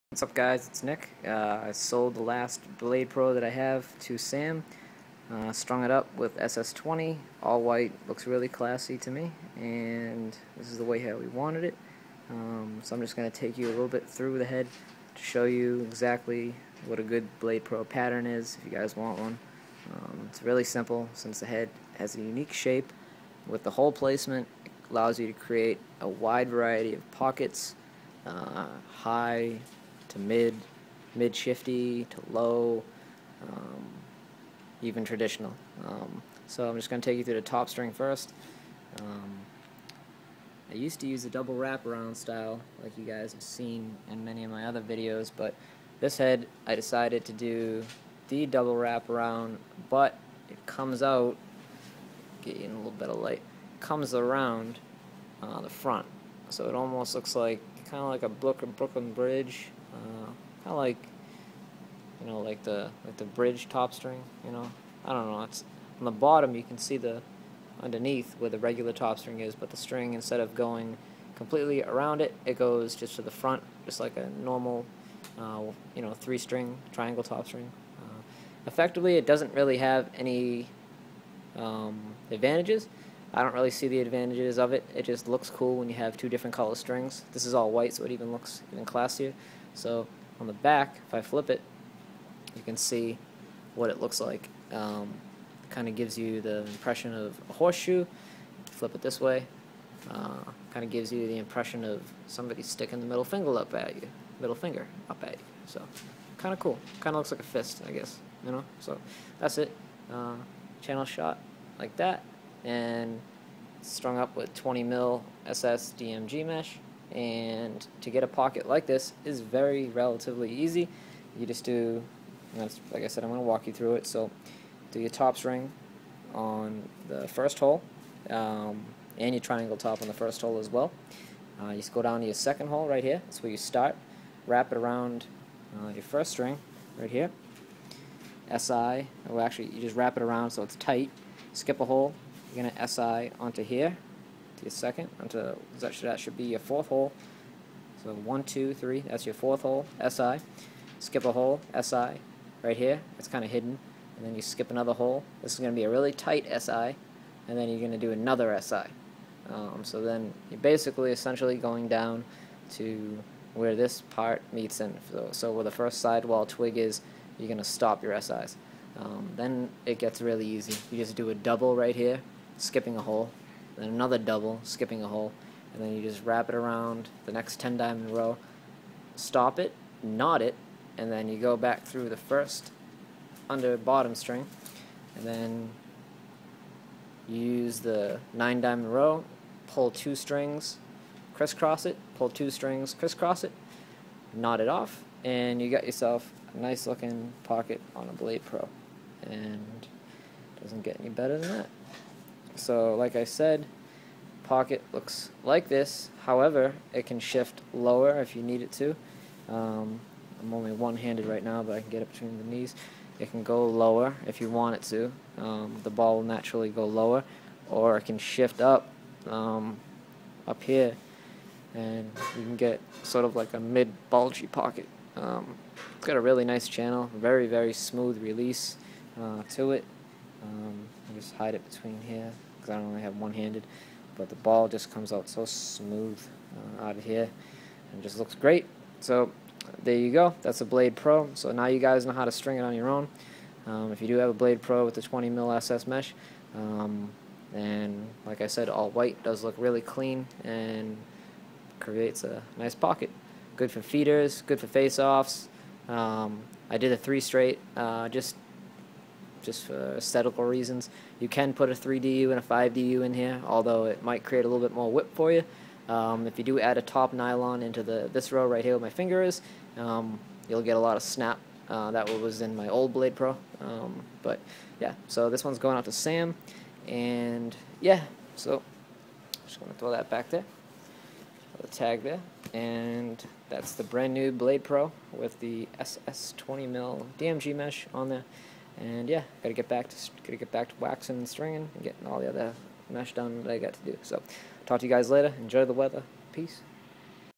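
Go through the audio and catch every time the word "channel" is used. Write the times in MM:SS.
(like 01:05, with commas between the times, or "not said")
01:50, 03:46.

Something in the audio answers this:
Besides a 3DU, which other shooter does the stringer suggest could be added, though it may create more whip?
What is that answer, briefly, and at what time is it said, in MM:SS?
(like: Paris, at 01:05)
5DU, at 04:22.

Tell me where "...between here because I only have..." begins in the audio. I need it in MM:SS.
03:51.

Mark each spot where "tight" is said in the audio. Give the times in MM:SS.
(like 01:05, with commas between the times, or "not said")
02:20, 02:36.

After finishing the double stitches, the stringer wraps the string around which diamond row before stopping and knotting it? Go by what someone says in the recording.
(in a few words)
10 diamond row.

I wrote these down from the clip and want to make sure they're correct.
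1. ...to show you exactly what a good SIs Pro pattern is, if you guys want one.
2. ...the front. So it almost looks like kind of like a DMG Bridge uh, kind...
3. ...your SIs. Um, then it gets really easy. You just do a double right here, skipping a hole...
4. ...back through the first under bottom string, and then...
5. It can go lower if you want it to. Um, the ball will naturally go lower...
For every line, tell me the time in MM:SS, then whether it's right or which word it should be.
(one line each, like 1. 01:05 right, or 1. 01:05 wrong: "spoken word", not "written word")
1. 00:15 wrong: "Blade", not "SIs"
2. 00:55 wrong: "Brooklyn", not "DMG"
3. 02:48 right
4. 03:01 right
5. 03:33 right.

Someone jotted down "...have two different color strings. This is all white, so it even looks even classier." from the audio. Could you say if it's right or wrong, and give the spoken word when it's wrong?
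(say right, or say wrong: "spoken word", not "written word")
right.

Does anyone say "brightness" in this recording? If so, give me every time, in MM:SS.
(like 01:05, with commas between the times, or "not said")
not said.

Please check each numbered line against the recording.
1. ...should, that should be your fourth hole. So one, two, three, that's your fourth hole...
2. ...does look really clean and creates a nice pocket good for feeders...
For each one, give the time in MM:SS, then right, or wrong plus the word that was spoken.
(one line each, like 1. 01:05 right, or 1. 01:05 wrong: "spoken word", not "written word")
1. 02:25 right
2. 04:09 right.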